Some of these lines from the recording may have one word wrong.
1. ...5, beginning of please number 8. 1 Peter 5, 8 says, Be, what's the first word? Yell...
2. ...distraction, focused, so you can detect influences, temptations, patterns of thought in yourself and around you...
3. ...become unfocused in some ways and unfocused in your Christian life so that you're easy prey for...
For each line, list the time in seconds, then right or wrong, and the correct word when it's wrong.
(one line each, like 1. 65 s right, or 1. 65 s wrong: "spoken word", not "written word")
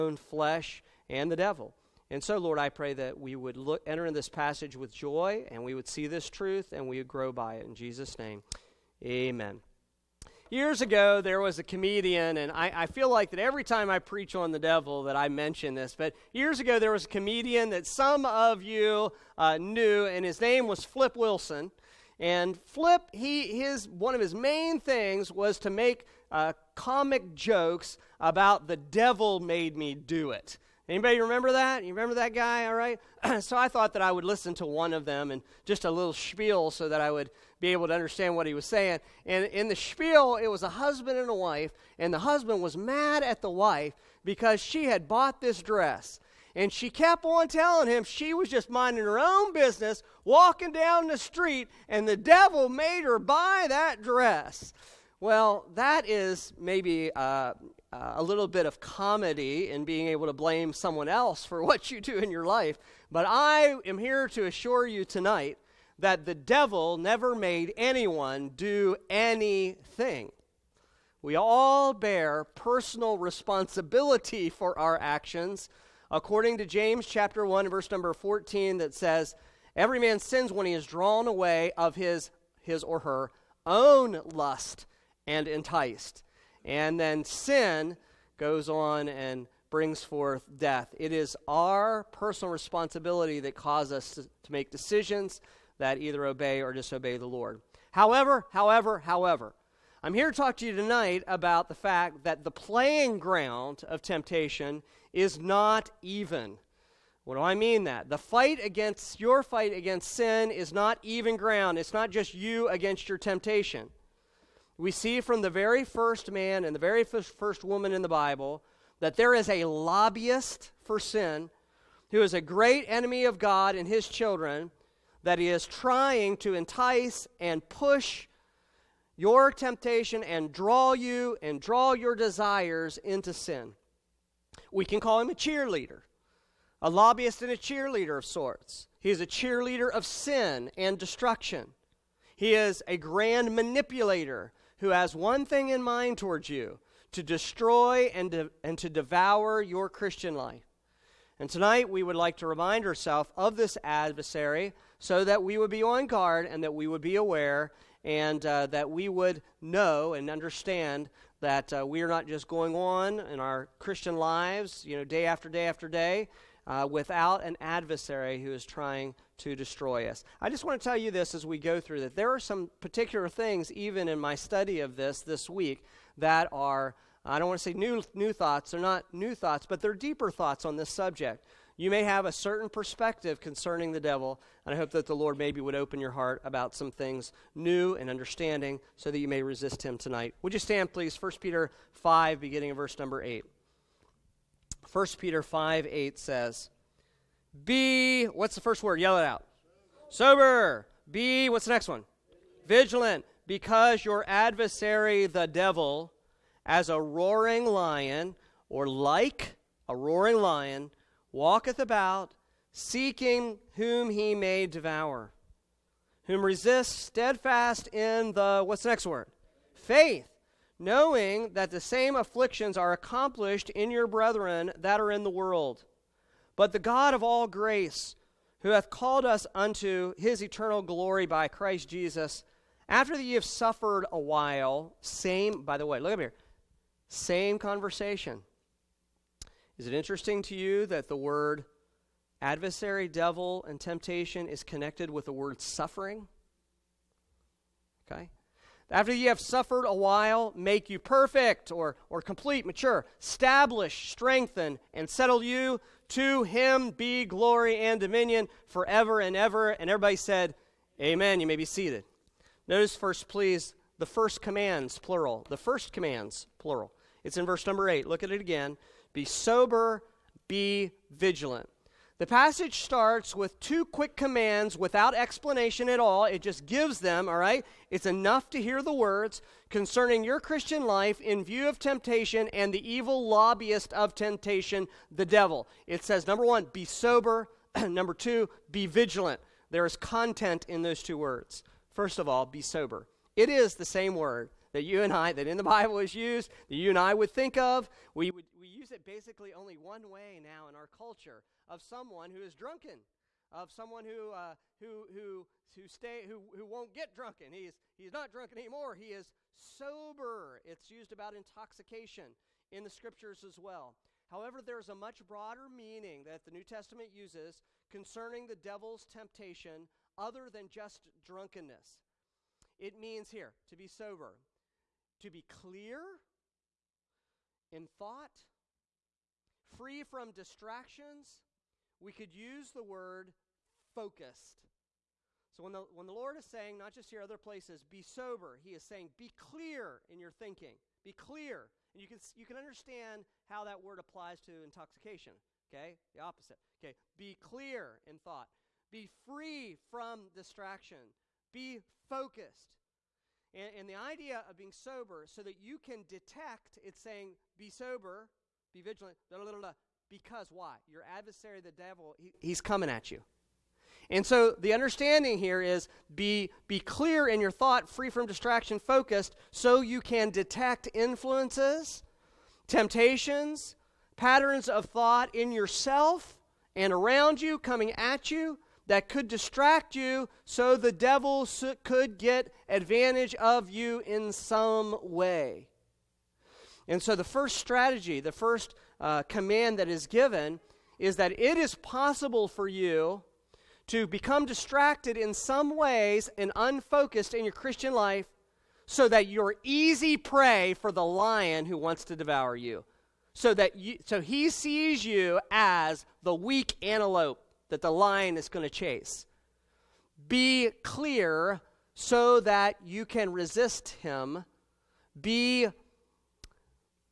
1. 191 s wrong: "verse", not "please"
2. 368 s right
3. 394 s wrong: "distracted", not "unfocused".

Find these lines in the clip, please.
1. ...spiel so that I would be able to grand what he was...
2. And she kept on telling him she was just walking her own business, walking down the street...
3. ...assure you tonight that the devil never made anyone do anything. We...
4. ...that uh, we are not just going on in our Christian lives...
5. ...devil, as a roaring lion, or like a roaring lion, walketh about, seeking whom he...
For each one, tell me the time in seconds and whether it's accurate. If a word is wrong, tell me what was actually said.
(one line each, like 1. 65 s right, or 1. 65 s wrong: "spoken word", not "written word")
1. 36 s wrong: "understand", not "grand"
2. 46 s wrong: "minding", not "walking"
3. 64 s right
4. 161 s right
5. 205 s right.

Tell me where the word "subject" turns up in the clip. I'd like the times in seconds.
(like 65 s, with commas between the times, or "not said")
180 s.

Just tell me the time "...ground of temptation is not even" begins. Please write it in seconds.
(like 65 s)
103 s.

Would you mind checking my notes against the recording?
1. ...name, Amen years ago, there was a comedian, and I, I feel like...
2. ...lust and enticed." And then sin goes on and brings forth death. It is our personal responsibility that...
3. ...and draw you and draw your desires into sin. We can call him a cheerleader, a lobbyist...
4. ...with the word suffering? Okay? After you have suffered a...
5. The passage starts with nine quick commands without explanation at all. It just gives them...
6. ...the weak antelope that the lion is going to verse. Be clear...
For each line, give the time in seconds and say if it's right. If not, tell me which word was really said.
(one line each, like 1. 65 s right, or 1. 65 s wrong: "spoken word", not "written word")
1. 8 s right
2. 84 s right
3. 130 s right
4. 245 s right
5. 272 s wrong: "two", not "nine"
6. 406 s wrong: "chase", not "verse".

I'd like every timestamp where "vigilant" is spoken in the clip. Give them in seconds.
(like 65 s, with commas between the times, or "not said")
202 s, 271 s, 288 s, 358 s.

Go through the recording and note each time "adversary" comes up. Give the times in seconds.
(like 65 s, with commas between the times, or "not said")
153 s, 167 s, 204 s, 242 s, 361 s.